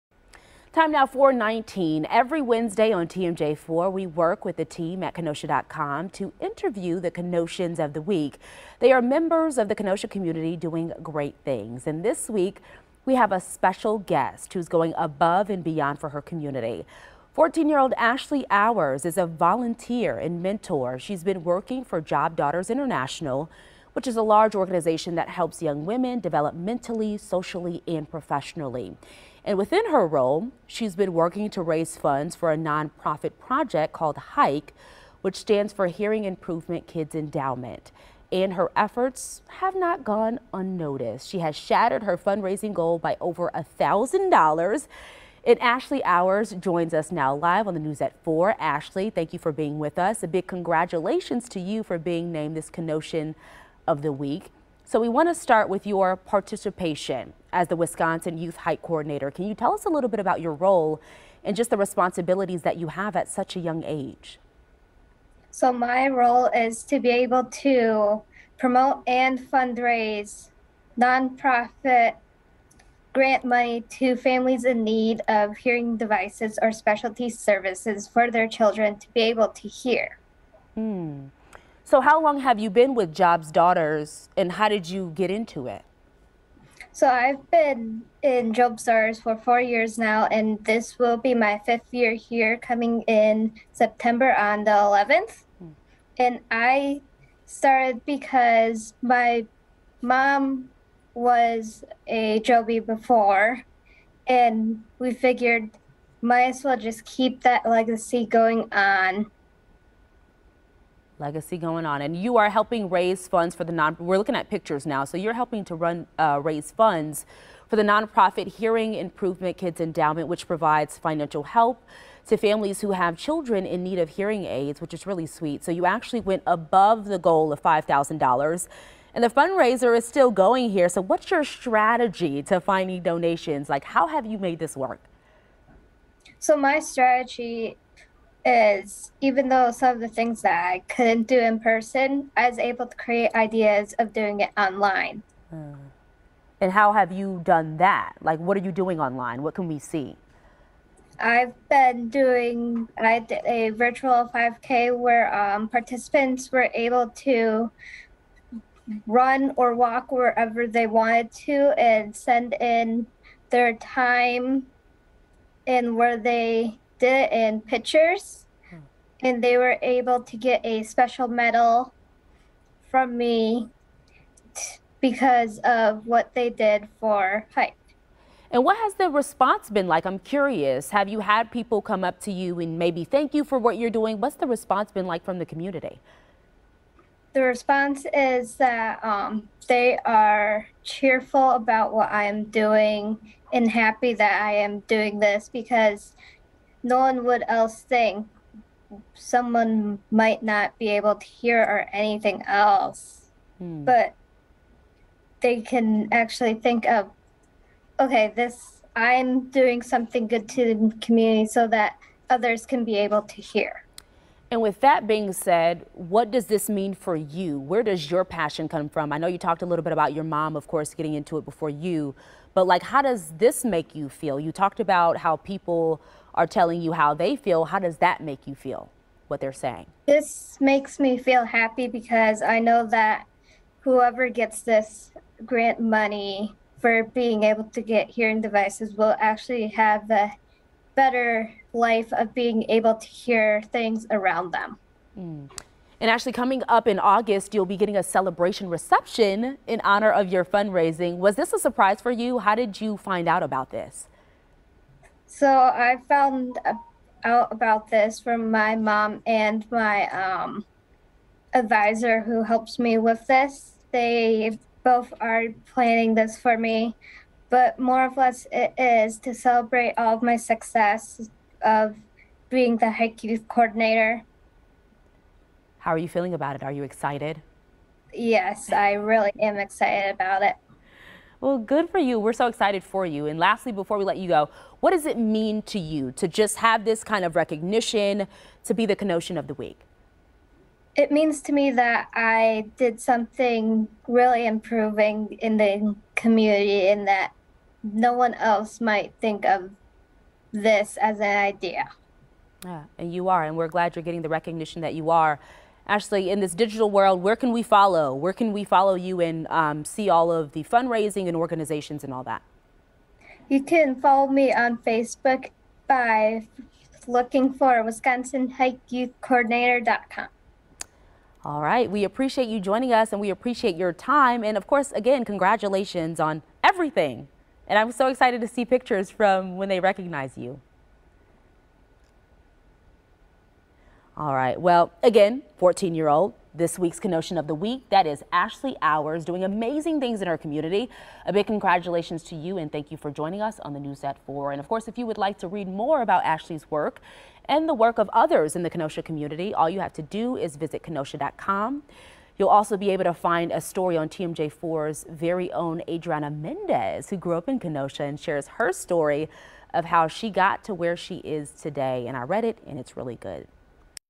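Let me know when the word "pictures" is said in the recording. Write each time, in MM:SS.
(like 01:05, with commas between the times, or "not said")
01:54, 02:47, 05:28.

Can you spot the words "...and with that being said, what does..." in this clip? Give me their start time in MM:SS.
03:34.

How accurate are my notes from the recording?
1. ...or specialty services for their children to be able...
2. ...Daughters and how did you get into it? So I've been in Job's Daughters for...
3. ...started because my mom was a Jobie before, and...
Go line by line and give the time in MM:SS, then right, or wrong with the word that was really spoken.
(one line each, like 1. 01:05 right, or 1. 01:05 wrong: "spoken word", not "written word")
1. 01:16 right
2. 01:23 right
3. 01:37 right.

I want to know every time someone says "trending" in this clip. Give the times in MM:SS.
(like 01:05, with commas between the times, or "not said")
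not said.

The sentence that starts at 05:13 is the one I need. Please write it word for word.
You can follow me on Facebook by looking for Wisconsin HIKE Youth Coordinator.com.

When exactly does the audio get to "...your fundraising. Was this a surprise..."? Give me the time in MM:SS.
04:10.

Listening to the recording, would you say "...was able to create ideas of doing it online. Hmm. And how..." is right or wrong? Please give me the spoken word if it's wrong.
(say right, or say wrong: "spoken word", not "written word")
right.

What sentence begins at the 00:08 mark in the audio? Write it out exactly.
They are members of the Kenosha community doing great things.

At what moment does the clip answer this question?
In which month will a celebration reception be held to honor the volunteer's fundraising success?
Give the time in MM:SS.
04:06.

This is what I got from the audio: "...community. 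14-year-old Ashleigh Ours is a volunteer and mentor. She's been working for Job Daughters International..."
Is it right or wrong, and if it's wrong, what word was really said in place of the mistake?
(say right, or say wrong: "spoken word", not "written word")
right.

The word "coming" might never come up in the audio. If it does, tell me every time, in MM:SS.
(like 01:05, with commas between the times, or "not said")
01:32, 04:06.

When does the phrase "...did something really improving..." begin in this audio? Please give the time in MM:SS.
04:52.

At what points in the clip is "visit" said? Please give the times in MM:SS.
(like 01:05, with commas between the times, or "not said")
05:50.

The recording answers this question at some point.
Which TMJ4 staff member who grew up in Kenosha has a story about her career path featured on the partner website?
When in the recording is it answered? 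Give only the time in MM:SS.
05:55.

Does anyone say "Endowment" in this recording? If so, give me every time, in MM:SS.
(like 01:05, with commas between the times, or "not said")
00:37, 01:59.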